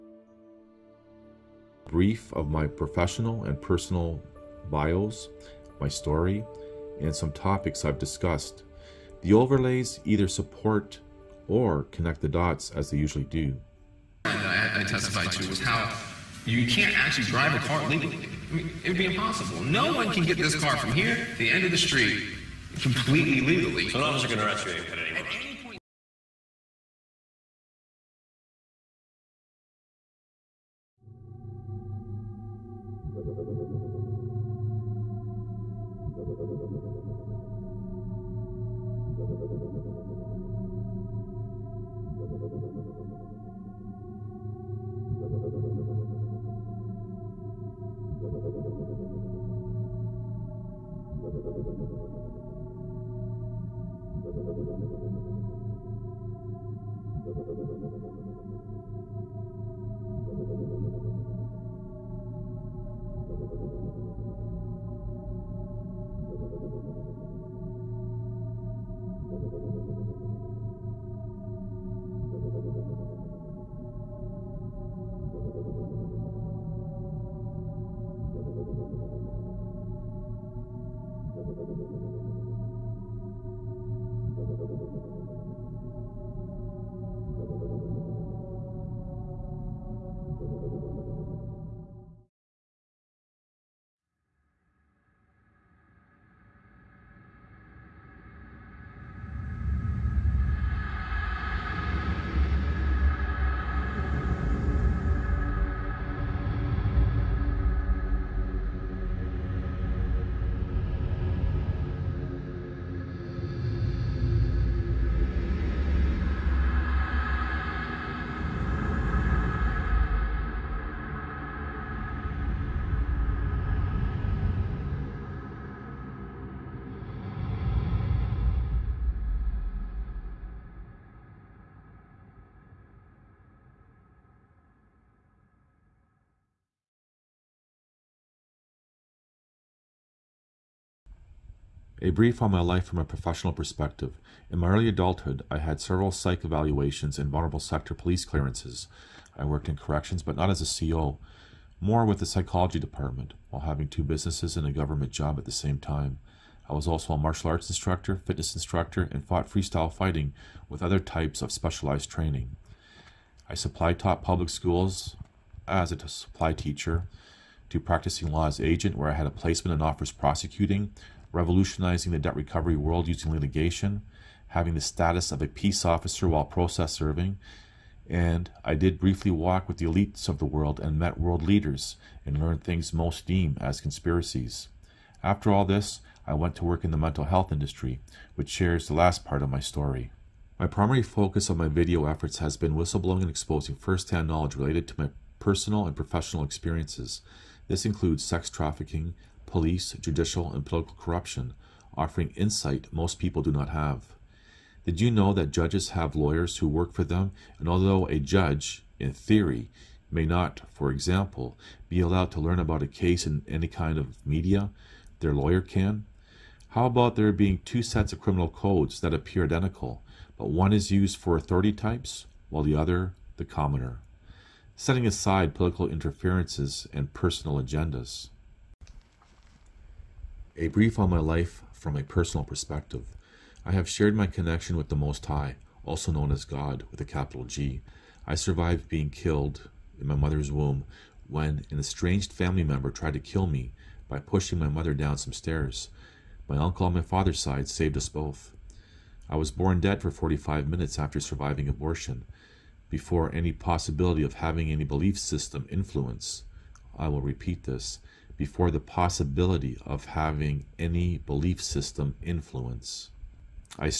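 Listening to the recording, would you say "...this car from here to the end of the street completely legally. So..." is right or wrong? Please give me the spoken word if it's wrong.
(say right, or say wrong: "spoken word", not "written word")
right.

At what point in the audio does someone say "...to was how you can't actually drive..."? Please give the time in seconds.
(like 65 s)
15 s.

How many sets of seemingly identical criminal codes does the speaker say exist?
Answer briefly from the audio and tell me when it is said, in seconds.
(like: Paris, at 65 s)
2, at 217 s.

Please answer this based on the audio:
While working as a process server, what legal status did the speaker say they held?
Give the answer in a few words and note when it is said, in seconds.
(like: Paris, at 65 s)
peace officer, at 175 s.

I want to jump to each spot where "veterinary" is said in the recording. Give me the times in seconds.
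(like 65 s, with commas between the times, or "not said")
not said.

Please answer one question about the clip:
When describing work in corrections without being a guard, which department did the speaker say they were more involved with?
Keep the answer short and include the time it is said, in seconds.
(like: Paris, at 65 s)
psychology department, at 152 s.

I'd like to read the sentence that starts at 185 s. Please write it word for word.
After all this, I went to work in the mental health industry, which shares the last part of my story.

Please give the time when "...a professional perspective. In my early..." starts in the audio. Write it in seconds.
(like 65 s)
142 s.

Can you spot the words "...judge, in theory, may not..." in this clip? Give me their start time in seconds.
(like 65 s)
208 s.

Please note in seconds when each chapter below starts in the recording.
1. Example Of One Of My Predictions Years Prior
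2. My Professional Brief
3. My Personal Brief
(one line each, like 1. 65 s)
1. 24 s
2. 140 s
3. 228 s.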